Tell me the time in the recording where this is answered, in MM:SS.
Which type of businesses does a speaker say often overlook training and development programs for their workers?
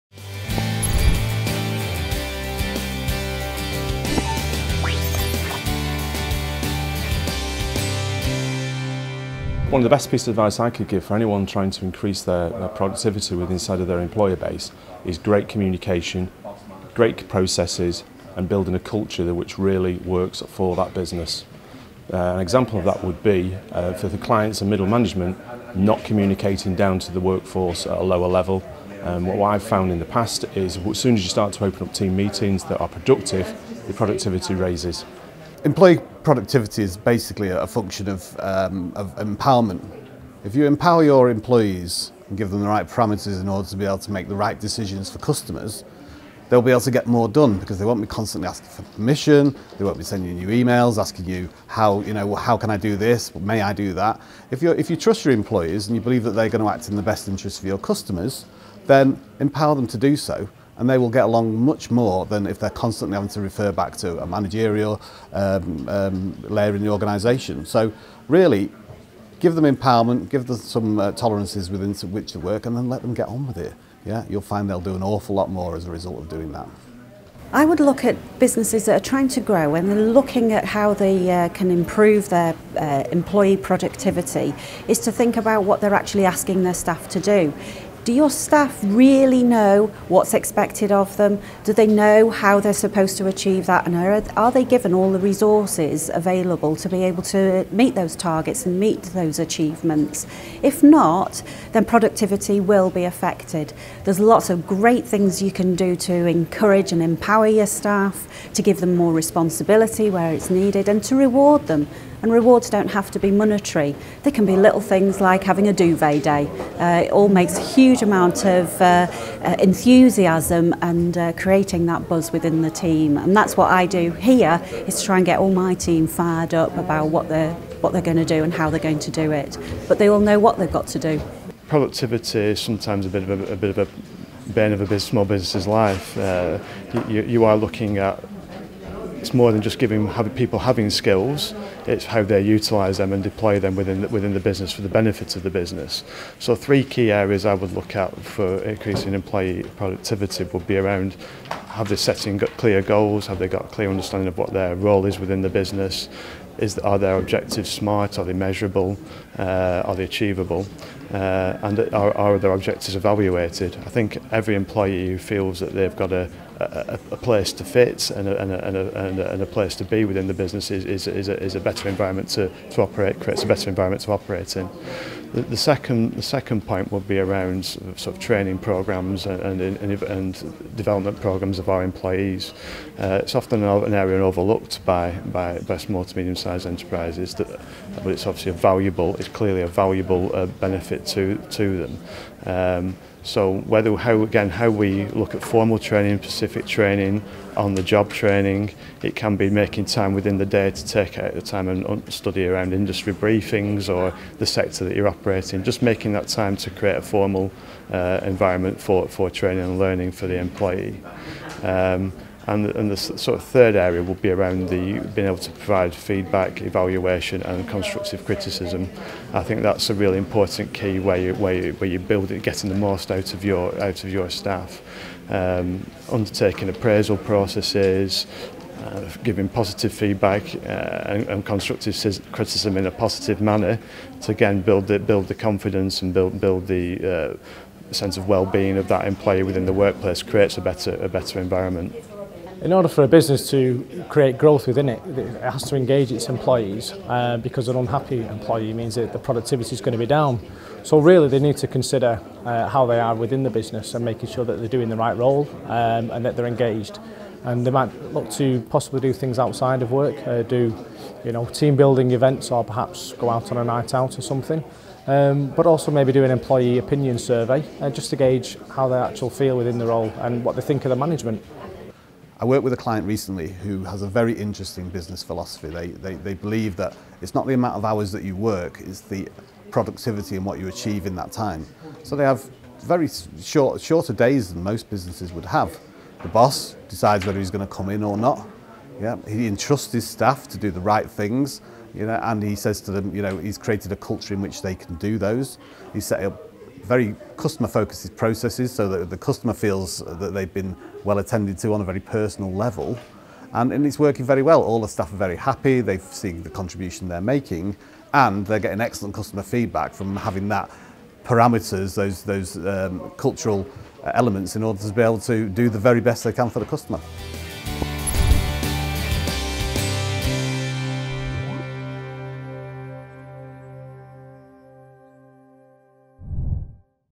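03:05.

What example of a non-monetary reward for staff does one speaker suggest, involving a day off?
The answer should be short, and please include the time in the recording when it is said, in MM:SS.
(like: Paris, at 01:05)
A duvet day, at 01:55.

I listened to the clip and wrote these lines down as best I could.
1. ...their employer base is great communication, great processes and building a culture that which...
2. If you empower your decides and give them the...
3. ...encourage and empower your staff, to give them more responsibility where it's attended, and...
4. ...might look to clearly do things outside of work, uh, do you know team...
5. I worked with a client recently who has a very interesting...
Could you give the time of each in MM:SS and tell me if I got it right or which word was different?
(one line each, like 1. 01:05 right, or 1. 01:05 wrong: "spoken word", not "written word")
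1. 00:13 right
2. 00:40 wrong: "employees", not "decides"
3. 01:46 wrong: "needed", not "attended"
4. 04:17 wrong: "possibly", not "clearly"
5. 04:32 right.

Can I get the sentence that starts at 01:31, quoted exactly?
Do they know how they're supposed to achieve that?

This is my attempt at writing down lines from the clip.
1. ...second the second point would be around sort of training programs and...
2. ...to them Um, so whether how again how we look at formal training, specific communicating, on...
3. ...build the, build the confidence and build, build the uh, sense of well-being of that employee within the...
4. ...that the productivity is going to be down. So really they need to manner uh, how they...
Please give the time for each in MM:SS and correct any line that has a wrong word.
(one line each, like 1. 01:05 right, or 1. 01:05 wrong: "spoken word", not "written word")
1. 02:55 right
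2. 03:11 wrong: "training", not "communicating"
3. 03:54 right
4. 04:08 wrong: "consider", not "manner".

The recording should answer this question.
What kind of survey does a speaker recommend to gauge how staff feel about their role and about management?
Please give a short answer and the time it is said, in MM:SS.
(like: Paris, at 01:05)
Employee opinion survey, at 04:26.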